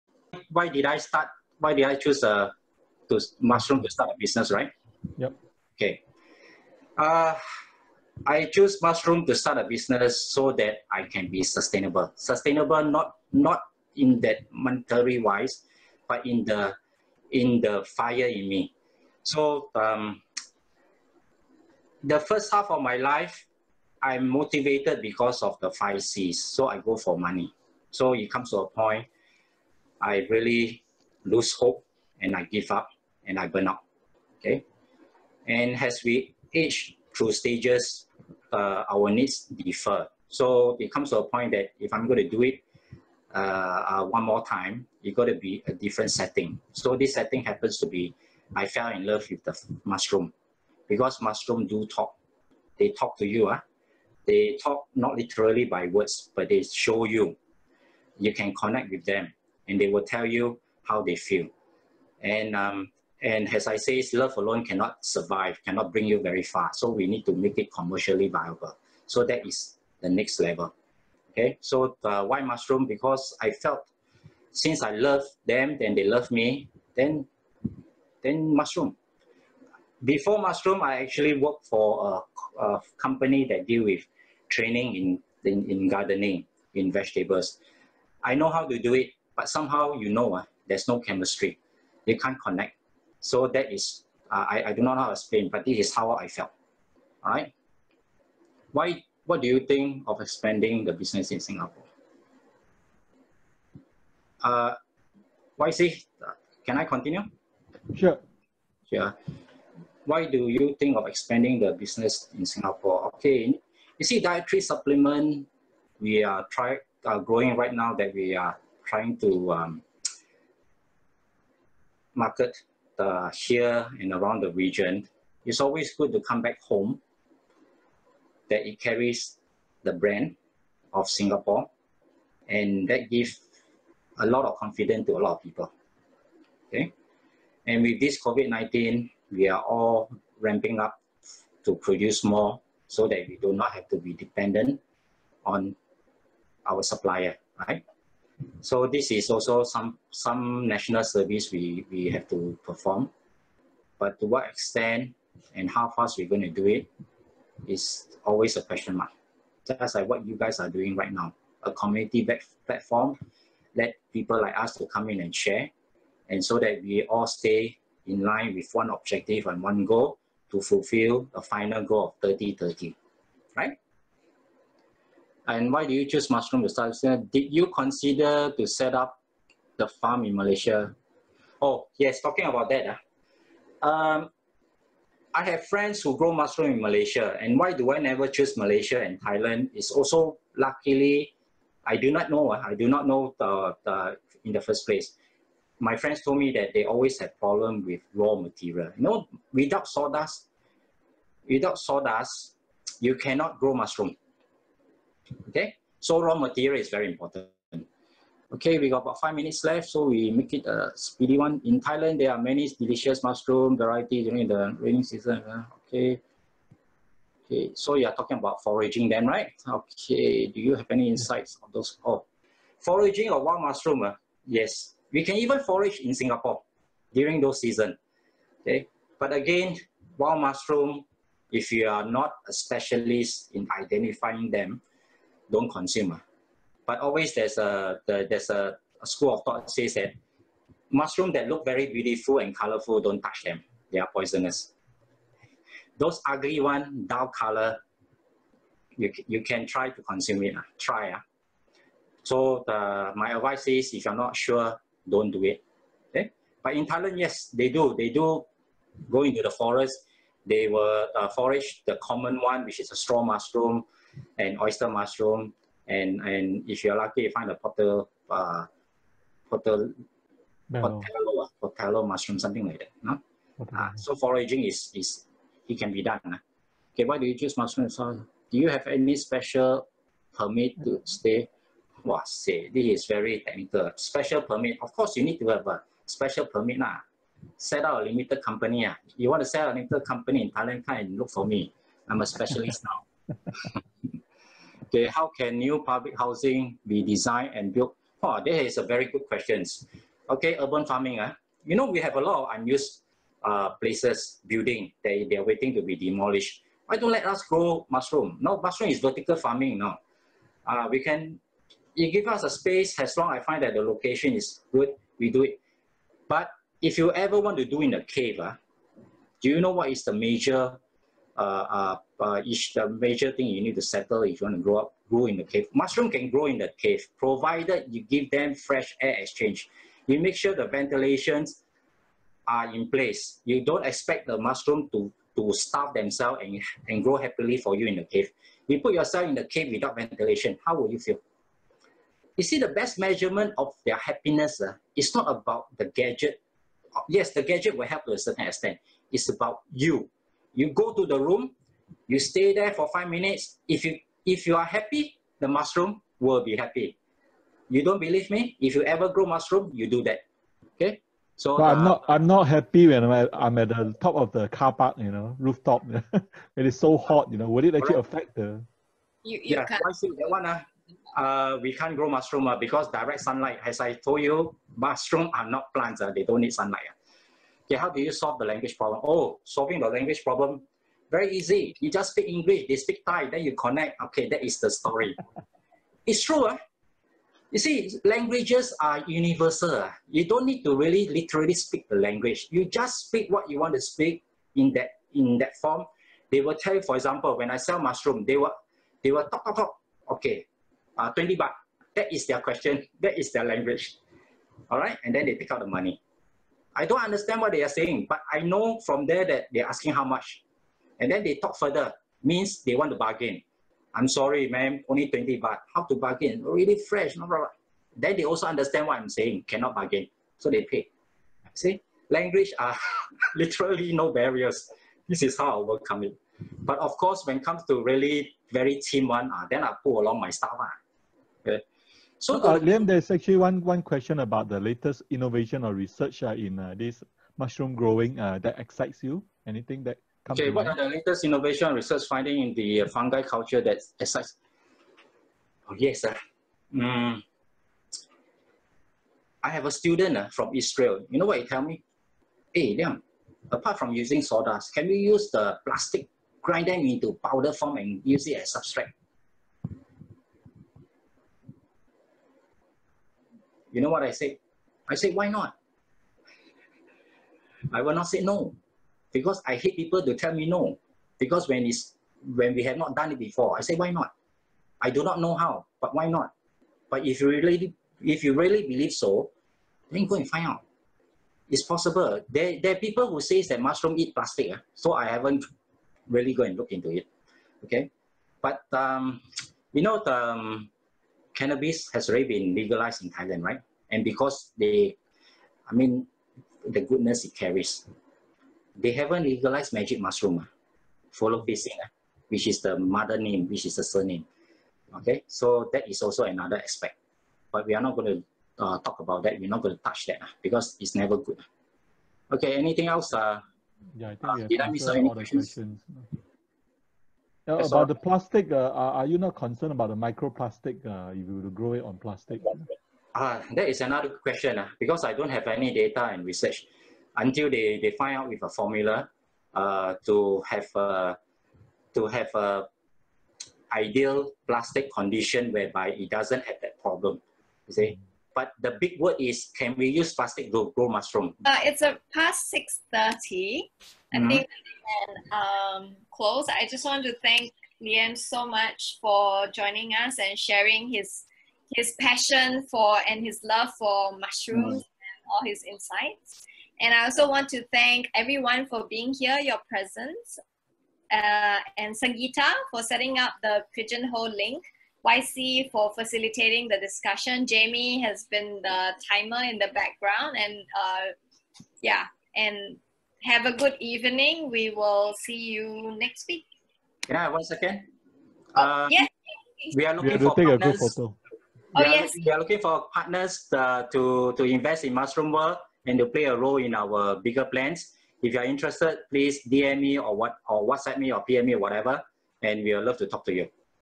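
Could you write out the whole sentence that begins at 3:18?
You know, without sawdust, without sawdust, you cannot grow mushroom.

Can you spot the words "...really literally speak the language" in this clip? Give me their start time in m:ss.
6:30.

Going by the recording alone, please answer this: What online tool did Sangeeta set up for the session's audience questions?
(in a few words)
Pigeonhole.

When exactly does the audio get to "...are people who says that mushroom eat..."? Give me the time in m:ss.
8:02.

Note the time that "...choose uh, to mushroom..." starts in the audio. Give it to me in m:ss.
0:01.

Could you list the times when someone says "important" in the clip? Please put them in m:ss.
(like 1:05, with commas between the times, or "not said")
3:27.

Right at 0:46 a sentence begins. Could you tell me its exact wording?
So this setting happens to be, I fell in love with the mushroom because mushroom do talk.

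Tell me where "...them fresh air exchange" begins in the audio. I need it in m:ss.
5:28.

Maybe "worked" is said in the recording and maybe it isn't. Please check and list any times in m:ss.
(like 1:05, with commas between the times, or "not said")
1:21.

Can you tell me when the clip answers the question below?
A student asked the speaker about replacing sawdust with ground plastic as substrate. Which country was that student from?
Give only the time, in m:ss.
7:30.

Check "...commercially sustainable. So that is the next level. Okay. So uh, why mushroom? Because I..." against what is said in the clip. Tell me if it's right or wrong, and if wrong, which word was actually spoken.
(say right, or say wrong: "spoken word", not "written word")
wrong: "viable", not "sustainable".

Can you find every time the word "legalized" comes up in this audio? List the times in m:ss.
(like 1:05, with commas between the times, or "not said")
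8:12, 8:19.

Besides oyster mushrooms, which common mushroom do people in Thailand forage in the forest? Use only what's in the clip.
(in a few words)
Straw mushroom.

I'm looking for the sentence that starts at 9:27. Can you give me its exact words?
Jamie has been the timer in the background, and uh, yeah, and have a good evening.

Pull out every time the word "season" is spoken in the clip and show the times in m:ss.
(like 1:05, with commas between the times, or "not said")
3:35, 3:47.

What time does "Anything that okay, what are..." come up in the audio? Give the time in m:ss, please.
7:19.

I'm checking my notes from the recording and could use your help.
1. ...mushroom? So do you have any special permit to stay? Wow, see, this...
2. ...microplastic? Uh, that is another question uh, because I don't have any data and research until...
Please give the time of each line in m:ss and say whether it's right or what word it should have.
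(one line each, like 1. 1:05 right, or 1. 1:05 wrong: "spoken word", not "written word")
1. 4:37 right
2. 8:41 wrong: "plastic", not "microplastic".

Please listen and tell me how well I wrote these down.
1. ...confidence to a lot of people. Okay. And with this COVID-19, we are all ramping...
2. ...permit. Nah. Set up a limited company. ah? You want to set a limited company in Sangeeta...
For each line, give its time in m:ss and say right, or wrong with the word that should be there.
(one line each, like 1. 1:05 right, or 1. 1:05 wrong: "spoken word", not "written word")
1. 2:14 right
2. 4:46 wrong: "Thailand", not "Sangeeta".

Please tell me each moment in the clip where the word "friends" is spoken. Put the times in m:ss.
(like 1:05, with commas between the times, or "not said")
3:05, 3:15.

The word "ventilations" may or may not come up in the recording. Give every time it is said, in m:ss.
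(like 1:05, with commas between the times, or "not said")
5:30, 5:39.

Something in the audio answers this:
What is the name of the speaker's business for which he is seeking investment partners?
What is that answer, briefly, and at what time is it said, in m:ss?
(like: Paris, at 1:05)
Mushroom World, at 9:44.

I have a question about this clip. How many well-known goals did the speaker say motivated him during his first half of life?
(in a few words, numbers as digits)
5.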